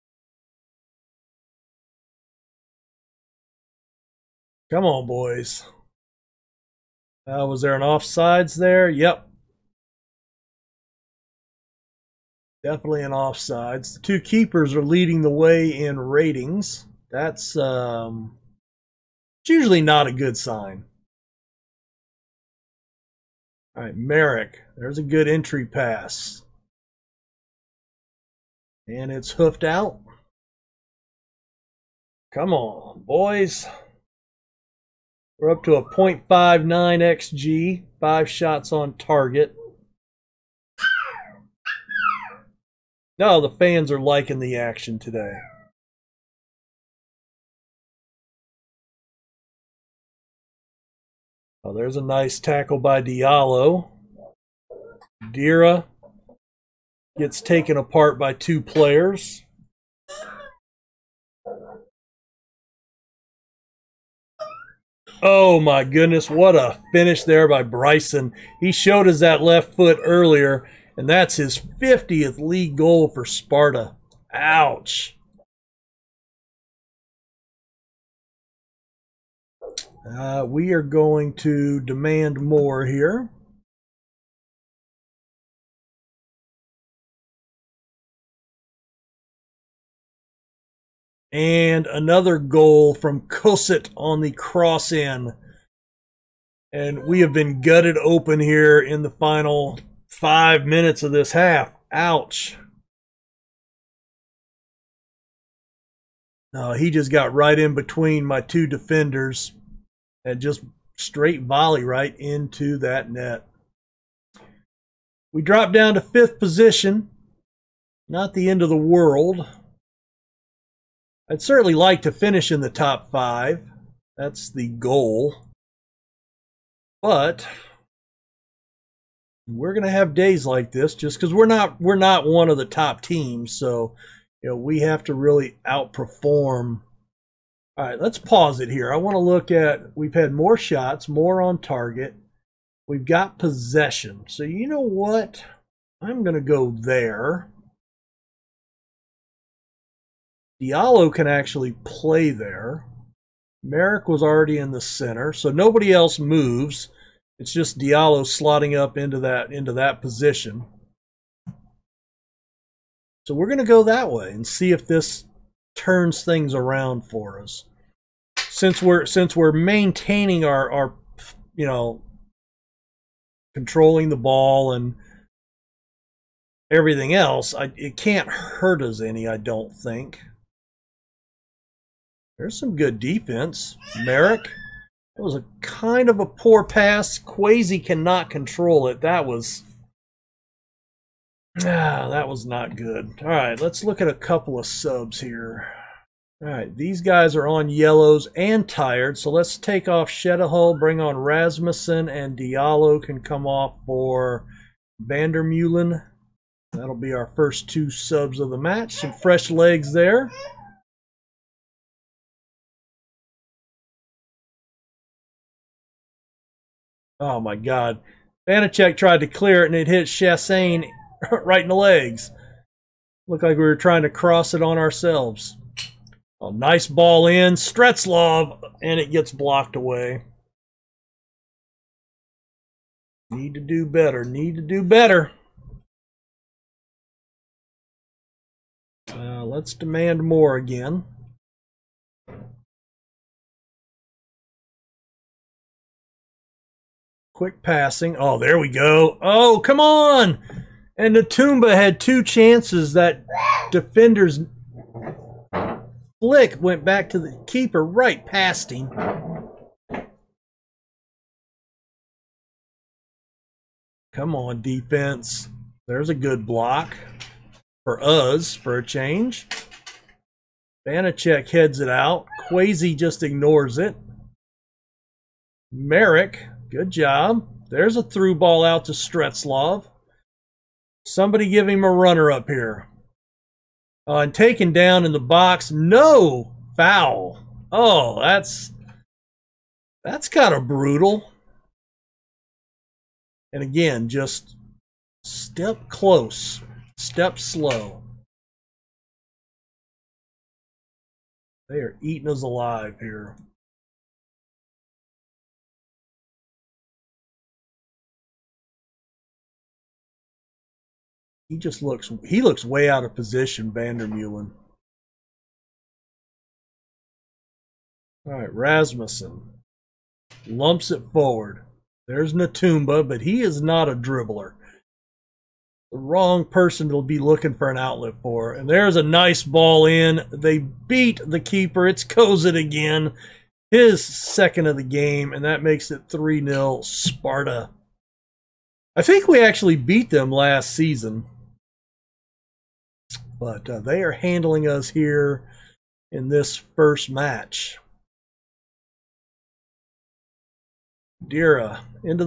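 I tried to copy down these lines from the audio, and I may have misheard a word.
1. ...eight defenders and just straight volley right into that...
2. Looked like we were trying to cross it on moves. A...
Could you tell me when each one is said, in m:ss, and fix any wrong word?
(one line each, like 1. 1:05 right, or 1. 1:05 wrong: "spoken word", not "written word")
1. 1:48 wrong: "two", not "eight"
2. 3:43 wrong: "ourselves", not "moves".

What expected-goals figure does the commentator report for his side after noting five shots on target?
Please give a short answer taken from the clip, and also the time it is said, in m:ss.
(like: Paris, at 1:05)
0.59, at 0:35.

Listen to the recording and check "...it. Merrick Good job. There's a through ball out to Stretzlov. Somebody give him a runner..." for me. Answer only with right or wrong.
right.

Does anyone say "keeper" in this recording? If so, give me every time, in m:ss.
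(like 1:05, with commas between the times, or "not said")
0:14, 4:17, 5:31.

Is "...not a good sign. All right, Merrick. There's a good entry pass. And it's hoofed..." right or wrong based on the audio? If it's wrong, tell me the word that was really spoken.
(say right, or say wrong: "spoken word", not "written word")
right.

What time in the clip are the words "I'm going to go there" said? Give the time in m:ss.
2:26.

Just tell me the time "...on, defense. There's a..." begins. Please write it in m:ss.
4:24.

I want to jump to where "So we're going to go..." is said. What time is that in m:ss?
2:43.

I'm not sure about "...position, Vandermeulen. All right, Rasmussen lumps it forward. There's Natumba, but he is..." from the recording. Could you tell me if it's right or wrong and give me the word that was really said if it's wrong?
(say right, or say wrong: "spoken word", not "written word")
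right.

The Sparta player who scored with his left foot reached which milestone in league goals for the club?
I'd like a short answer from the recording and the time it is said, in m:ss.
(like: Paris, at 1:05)
50th, at 1:11.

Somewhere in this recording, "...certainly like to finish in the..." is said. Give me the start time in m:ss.
2:01.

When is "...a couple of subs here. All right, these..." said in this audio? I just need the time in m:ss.
3:14.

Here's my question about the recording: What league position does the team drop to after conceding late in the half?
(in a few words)
fifth.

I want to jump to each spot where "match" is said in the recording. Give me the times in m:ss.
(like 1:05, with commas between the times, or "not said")
3:28, 5:47.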